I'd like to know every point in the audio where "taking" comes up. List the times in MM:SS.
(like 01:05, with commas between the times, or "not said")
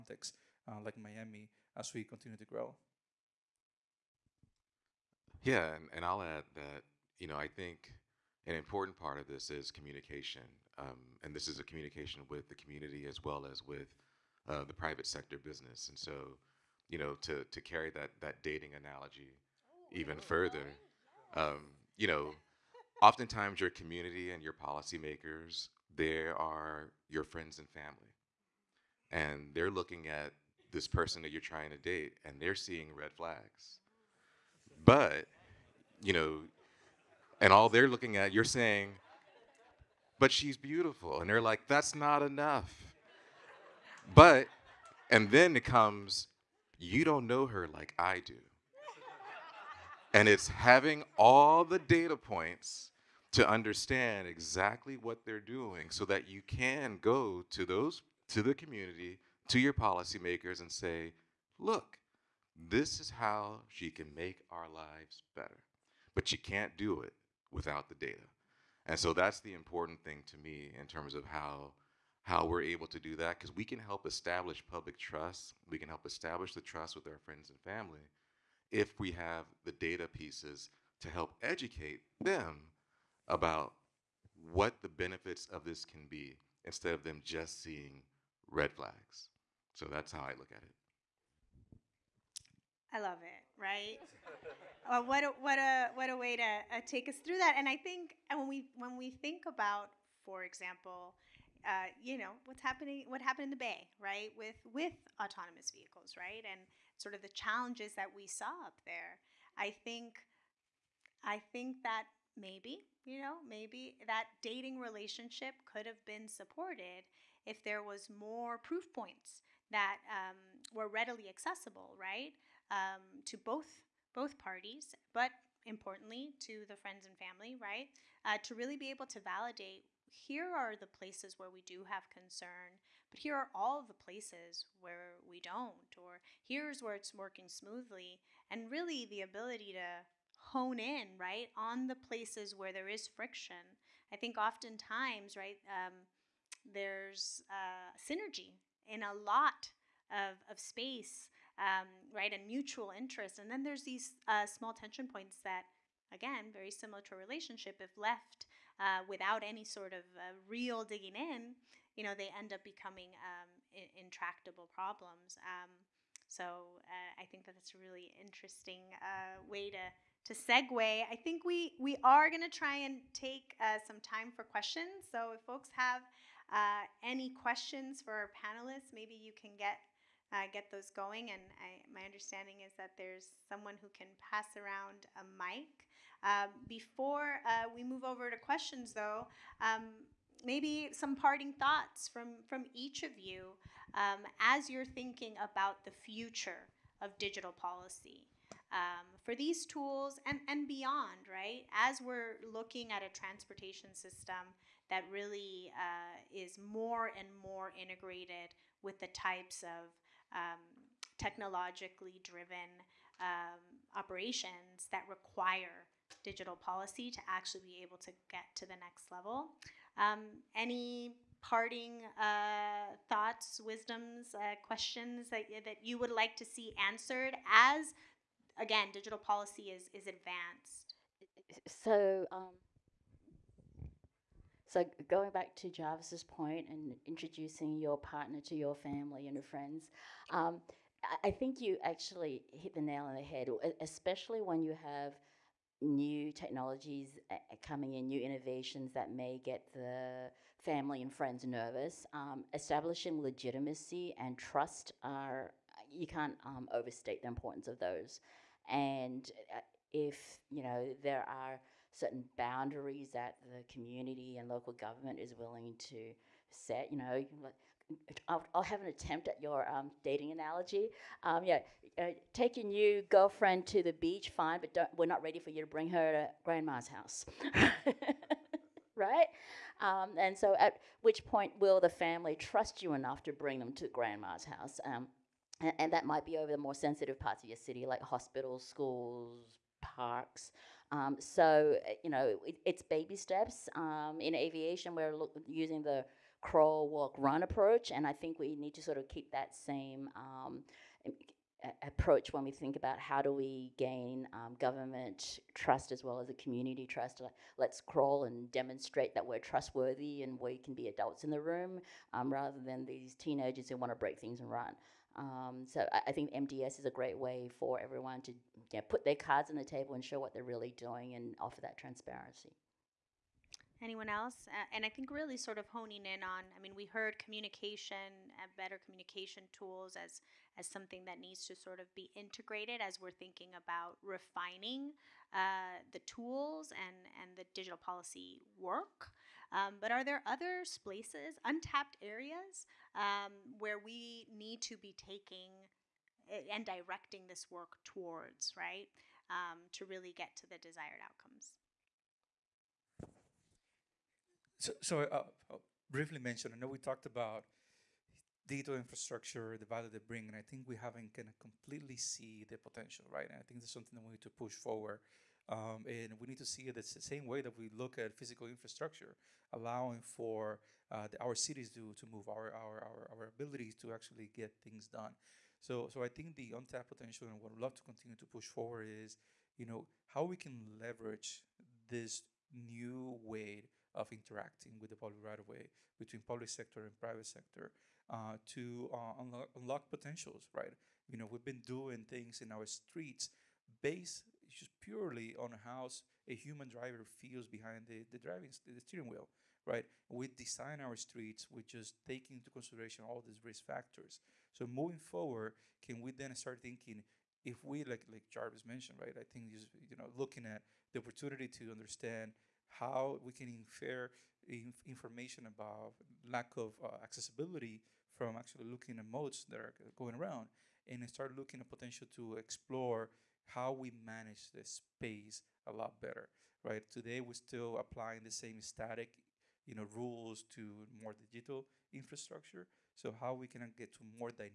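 05:44, 06:42.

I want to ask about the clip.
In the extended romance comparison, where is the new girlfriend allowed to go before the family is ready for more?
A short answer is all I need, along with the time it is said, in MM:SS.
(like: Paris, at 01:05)
the beach, at 04:33.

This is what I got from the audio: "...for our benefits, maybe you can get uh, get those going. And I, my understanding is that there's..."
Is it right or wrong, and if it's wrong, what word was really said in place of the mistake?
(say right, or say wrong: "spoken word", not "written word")
wrong: "panelists", not "benefits".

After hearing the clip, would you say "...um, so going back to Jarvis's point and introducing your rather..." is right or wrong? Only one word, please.
wrong.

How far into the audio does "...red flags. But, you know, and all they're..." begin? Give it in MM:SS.
00:32.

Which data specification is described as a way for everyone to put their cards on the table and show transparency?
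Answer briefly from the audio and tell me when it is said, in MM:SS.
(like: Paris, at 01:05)
MDS, at 05:16.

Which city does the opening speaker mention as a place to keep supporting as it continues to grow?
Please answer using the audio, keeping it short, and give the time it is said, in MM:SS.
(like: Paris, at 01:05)
Miami, at 00:00.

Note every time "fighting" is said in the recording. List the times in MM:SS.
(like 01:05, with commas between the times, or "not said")
not said.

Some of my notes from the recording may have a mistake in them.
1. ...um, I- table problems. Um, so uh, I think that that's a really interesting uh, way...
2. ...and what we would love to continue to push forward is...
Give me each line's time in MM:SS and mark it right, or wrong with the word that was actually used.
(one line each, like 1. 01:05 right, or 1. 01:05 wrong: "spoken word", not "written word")
1. 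02:43 wrong: "intractable", not "table"
2. 06:17 right.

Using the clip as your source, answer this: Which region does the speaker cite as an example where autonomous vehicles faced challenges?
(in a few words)
the Bay.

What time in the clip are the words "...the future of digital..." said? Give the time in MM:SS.
03:15.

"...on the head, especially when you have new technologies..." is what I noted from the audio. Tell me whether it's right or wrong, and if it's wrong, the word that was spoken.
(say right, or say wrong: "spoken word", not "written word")
right.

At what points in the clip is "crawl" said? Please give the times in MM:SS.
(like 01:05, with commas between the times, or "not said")
04:56, 05:07.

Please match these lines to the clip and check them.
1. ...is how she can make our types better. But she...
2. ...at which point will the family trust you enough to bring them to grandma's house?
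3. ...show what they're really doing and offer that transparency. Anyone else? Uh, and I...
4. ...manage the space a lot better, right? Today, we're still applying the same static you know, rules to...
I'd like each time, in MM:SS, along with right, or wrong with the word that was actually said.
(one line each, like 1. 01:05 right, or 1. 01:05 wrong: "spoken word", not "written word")
1. 01:02 wrong: "lives", not "types"
2. 04:40 right
3. 05:20 right
4. 07:04 right.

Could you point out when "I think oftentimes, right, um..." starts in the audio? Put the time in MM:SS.
02:24.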